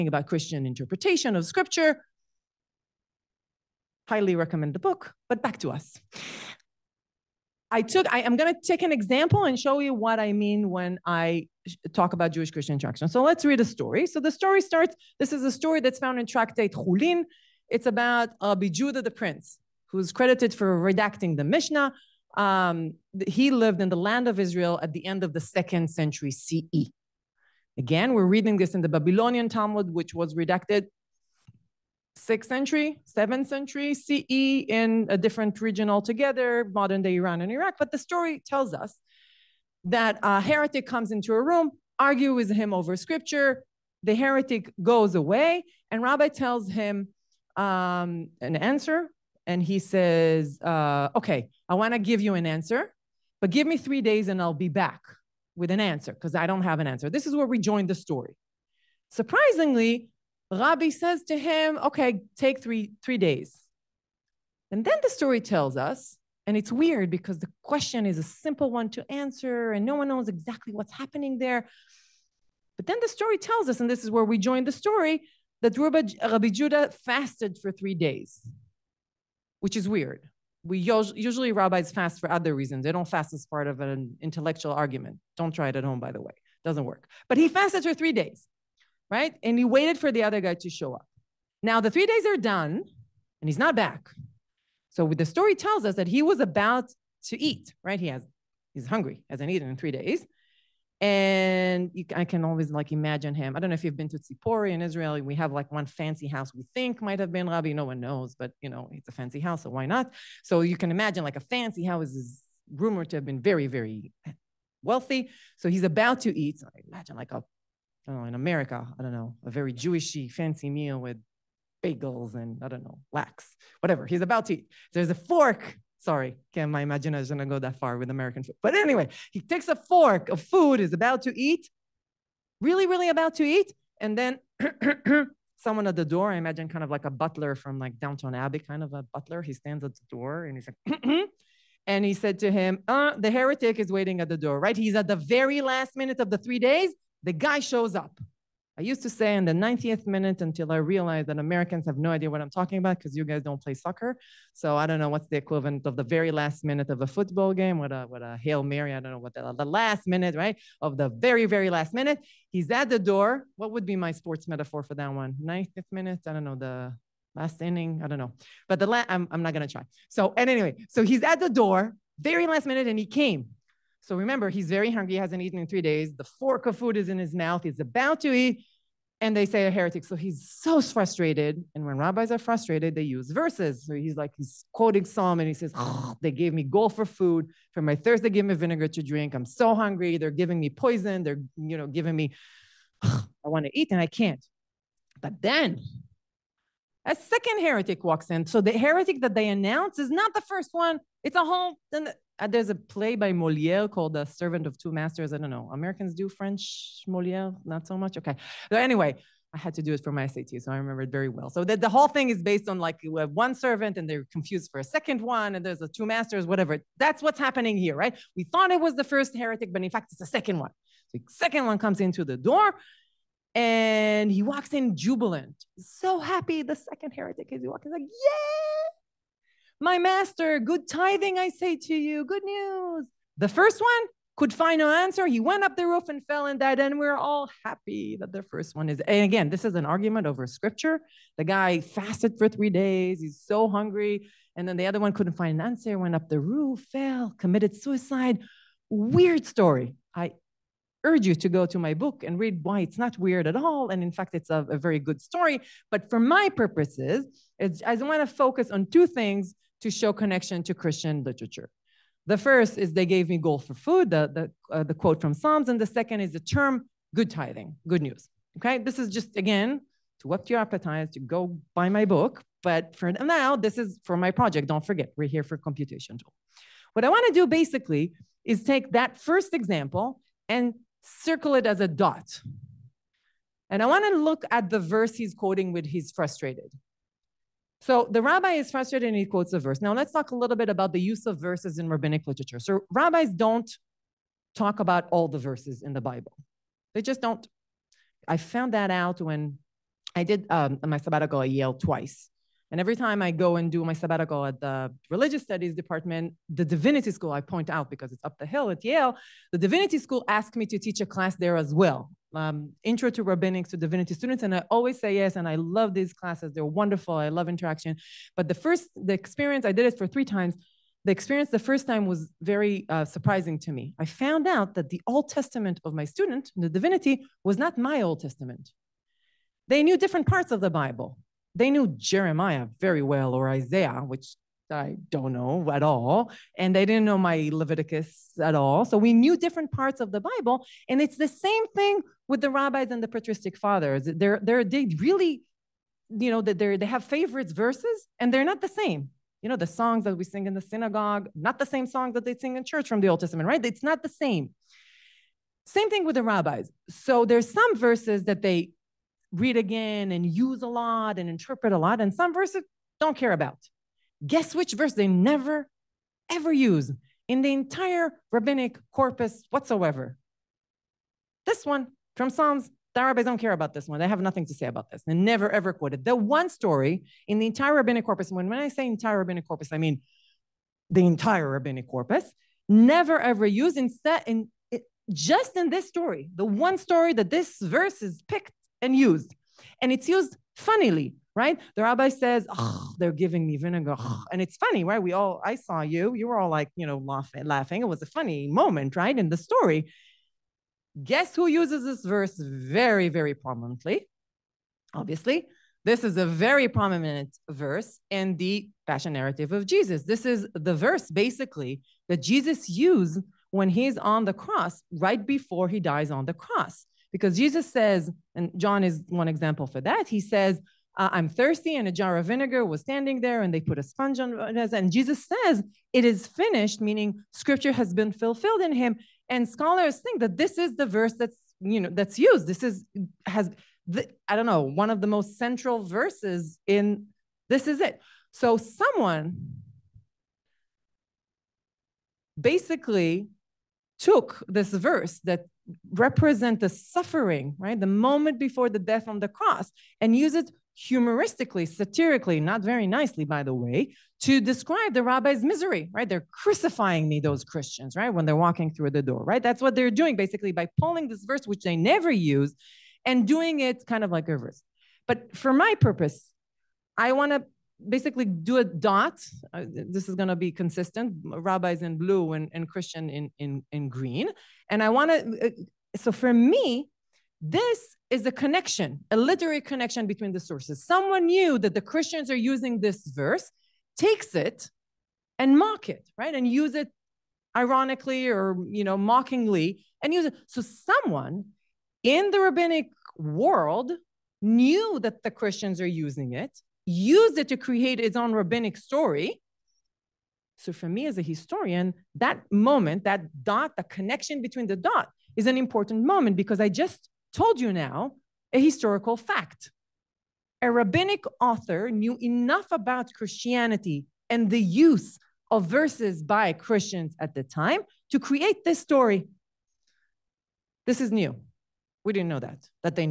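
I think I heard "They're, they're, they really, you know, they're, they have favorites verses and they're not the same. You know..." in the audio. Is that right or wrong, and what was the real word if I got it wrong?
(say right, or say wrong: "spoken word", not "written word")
right.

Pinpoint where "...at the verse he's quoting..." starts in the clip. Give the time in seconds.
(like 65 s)
284 s.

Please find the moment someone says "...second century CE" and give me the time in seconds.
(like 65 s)
25 s.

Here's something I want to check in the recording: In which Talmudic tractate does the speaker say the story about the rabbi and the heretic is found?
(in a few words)
Chulin.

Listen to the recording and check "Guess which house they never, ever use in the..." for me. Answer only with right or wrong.
wrong.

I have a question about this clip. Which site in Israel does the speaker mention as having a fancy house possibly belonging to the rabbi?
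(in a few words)
Tzipori.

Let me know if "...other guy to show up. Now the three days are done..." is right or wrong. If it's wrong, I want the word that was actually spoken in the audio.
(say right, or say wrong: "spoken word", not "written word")
right.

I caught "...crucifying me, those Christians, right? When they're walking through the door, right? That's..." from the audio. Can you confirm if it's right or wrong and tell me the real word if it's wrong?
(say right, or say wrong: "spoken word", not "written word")
right.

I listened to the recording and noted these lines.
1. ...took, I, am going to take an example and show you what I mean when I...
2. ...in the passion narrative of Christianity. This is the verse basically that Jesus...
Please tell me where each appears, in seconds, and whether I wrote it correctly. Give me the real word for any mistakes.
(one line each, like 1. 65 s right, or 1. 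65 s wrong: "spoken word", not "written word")
1. 7 s right
2. 408 s wrong: "Jesus", not "Christianity".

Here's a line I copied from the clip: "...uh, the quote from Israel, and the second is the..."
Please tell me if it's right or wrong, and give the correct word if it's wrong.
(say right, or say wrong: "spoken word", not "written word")
wrong: "Psalms", not "Israel".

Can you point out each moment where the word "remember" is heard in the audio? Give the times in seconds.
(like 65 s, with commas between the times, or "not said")
174 s, 210 s.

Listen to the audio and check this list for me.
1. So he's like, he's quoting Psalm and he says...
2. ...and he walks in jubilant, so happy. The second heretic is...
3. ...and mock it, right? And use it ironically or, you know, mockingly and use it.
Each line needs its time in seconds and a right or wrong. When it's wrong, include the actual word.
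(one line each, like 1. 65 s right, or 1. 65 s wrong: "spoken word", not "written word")
1. 183 s right
2. 223 s right
3. 485 s right.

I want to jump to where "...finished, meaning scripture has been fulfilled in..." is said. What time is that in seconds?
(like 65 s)
426 s.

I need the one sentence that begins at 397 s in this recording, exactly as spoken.
It was a funny moment, right?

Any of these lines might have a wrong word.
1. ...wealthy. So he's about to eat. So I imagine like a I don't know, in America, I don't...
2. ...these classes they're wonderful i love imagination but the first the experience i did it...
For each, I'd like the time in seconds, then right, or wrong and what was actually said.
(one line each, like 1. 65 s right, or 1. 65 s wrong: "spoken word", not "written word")
1. 114 s right
2. 315 s wrong: "interaction", not "imagination".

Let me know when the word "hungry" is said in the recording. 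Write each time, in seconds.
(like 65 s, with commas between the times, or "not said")
98 s, 174 s, 189 s, 243 s.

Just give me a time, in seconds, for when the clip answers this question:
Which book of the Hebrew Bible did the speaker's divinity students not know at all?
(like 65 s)
337 s.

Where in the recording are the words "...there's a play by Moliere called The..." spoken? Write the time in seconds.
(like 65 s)
202 s.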